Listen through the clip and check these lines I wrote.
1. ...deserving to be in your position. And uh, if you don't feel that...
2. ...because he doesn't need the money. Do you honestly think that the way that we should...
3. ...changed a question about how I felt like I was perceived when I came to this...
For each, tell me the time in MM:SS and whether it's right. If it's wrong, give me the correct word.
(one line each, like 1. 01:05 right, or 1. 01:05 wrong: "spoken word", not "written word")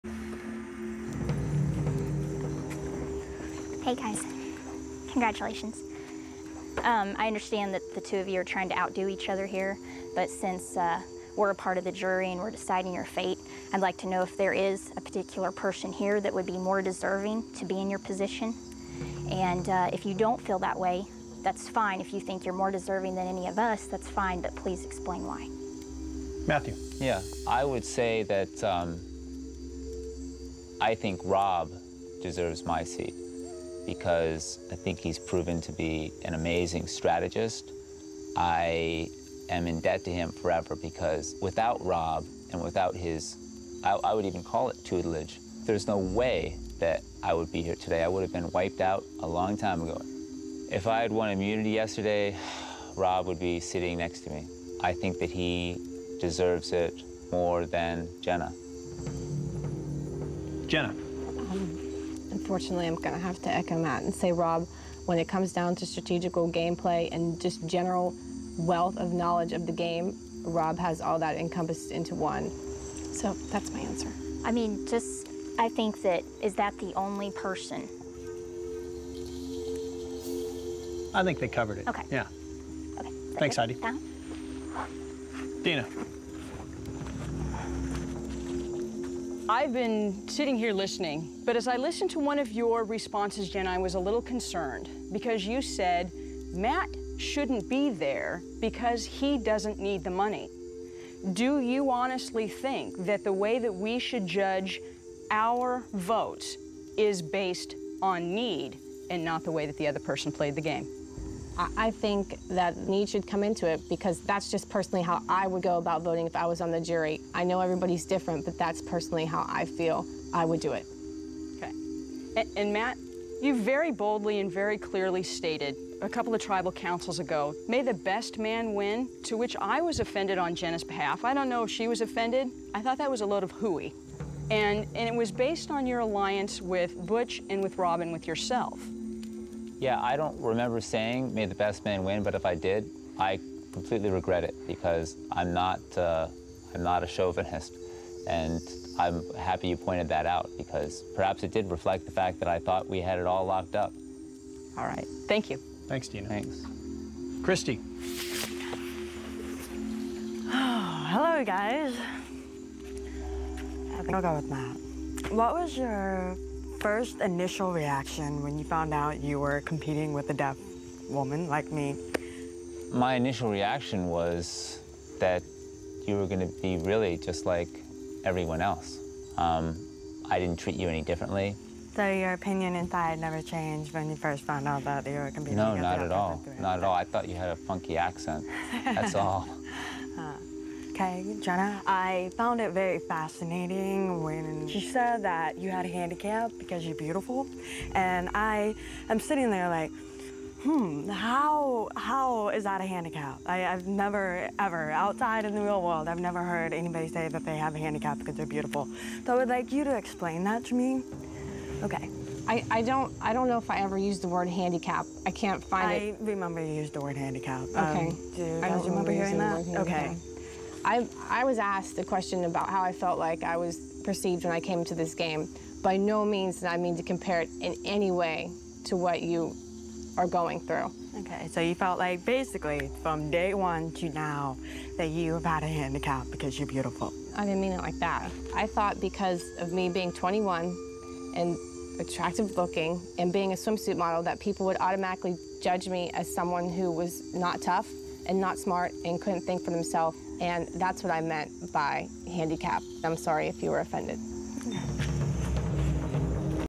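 1. 00:16 right
2. 01:38 right
3. 03:41 wrong: "asked", not "changed".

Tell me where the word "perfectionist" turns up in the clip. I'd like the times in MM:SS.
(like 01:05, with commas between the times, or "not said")
not said.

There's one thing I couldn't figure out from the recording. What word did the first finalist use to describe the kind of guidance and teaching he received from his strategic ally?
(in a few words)
tutelage.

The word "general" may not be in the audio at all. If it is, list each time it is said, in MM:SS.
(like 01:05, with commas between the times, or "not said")
01:07.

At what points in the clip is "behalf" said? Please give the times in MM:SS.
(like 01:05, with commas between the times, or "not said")
02:10.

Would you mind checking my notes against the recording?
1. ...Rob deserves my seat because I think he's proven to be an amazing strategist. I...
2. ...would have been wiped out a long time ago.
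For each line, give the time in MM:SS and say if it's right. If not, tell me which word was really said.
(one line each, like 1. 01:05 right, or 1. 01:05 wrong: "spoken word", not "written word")
1. 00:31 right
2. 00:48 right.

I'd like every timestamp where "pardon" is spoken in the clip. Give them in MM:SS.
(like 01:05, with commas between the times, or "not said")
not said.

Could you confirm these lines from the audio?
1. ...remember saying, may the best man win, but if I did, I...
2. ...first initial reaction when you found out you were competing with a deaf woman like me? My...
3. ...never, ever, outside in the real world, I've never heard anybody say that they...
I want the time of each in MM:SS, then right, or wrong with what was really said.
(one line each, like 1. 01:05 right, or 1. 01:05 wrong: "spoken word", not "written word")
1. 02:20 right
2. 02:46 right
3. 03:23 right.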